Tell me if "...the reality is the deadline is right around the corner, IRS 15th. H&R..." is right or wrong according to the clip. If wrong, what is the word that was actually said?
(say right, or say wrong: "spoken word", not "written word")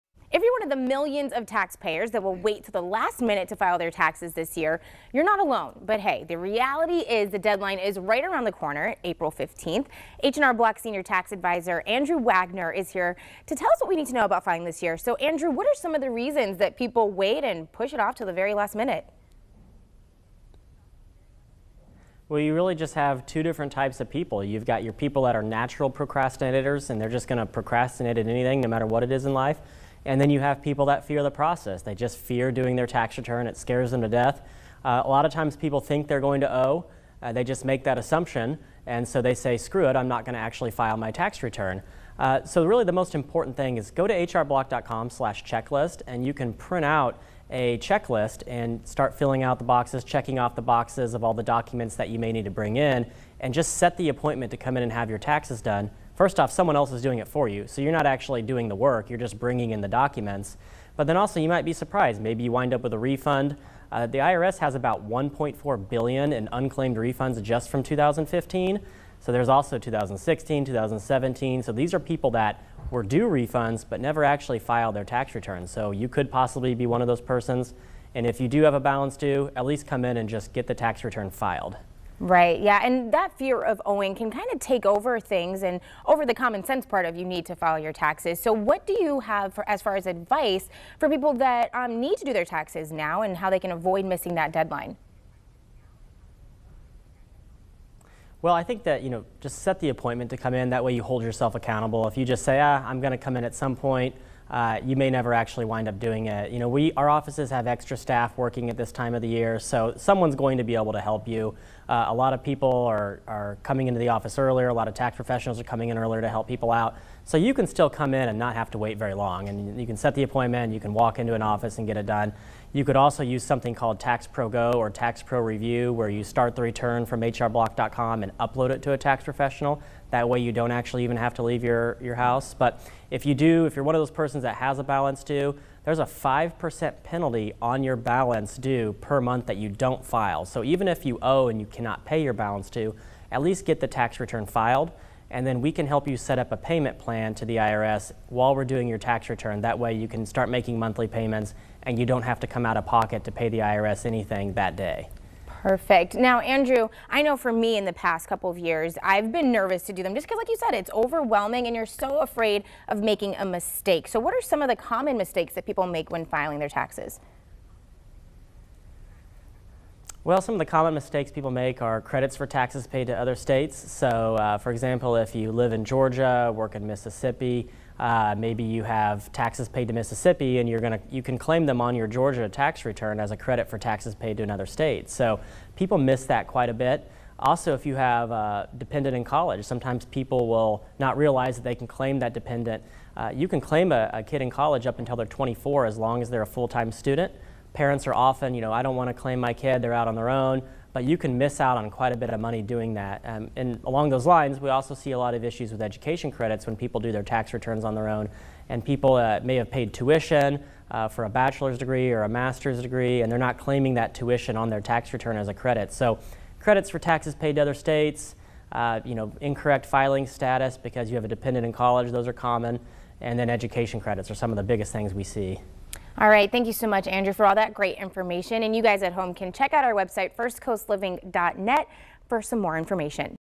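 wrong: "April", not "IRS".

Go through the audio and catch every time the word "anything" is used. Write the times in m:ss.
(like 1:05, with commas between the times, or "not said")
0:28, 2:34.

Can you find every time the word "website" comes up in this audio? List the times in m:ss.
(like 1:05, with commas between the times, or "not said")
3:49.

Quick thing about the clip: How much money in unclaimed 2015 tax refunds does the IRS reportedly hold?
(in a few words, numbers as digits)
1.4 billion.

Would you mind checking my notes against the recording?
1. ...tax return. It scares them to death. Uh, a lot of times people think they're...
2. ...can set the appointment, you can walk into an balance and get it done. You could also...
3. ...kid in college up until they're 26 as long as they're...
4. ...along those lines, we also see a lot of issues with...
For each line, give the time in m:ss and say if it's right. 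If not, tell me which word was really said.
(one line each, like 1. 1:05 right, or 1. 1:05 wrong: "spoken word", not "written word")
1. 0:32 right
2. 1:59 wrong: "office", not "balance"
3. 3:14 wrong: "24", not "26"
4. 3:23 right.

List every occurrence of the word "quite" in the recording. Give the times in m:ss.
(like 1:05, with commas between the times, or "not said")
3:06, 3:21.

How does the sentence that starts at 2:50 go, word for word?
Well, some of the common mistakes people make are credits for taxes paid to other states.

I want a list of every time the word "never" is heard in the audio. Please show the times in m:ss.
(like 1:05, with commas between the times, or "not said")
1:13, 1:45.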